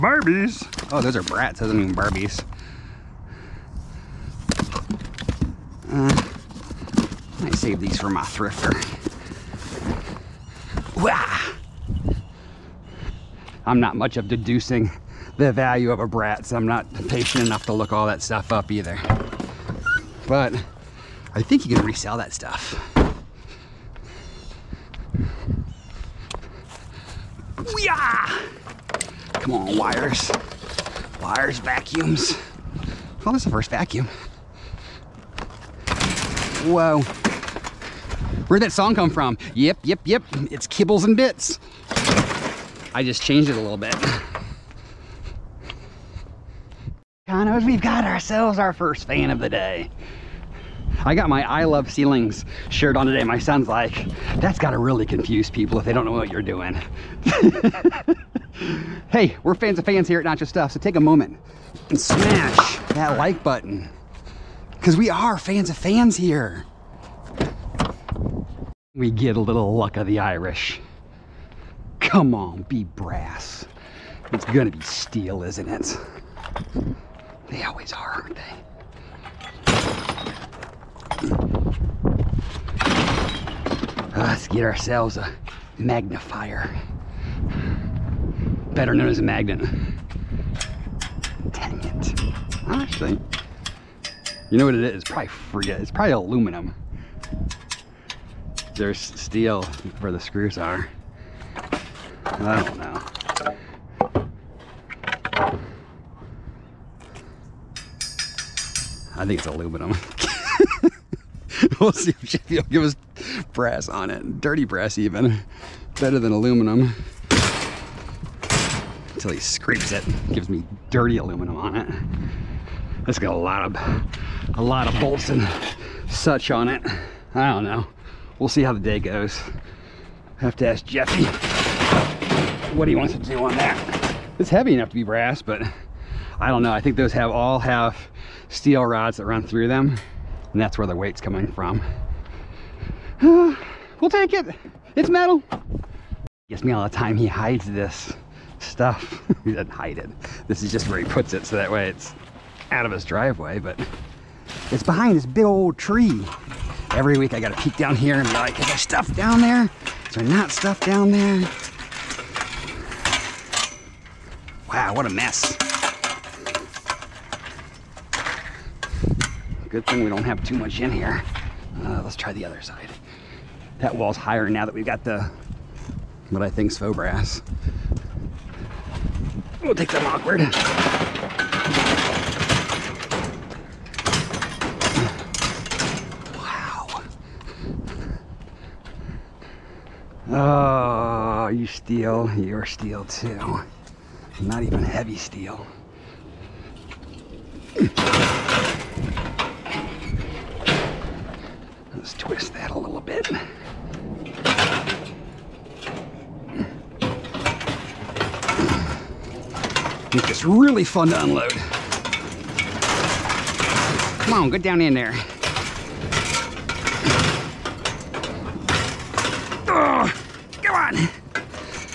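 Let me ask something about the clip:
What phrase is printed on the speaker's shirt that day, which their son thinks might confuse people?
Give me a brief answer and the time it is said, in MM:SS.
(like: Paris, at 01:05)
I love ceilings, at 00:51.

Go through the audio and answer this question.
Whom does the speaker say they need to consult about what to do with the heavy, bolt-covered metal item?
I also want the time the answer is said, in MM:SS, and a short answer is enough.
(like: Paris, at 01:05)
Jeffy, at 02:10.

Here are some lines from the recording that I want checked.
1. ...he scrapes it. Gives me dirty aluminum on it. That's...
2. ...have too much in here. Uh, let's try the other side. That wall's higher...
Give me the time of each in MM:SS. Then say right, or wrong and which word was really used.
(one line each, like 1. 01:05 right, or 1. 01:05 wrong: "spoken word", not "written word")
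1. 01:59 right
2. 02:50 right.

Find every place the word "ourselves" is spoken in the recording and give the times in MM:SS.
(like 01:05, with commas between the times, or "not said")
00:48, 01:24.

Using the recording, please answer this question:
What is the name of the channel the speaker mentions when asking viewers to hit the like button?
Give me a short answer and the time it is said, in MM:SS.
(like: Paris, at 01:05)
Nacho Stuff, at 01:00.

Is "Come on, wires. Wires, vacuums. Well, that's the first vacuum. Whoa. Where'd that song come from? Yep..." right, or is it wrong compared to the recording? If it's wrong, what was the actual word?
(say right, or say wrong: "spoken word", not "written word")
right.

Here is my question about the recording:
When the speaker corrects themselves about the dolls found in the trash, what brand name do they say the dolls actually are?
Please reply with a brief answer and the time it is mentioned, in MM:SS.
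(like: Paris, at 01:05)
Bratz, at 00:01.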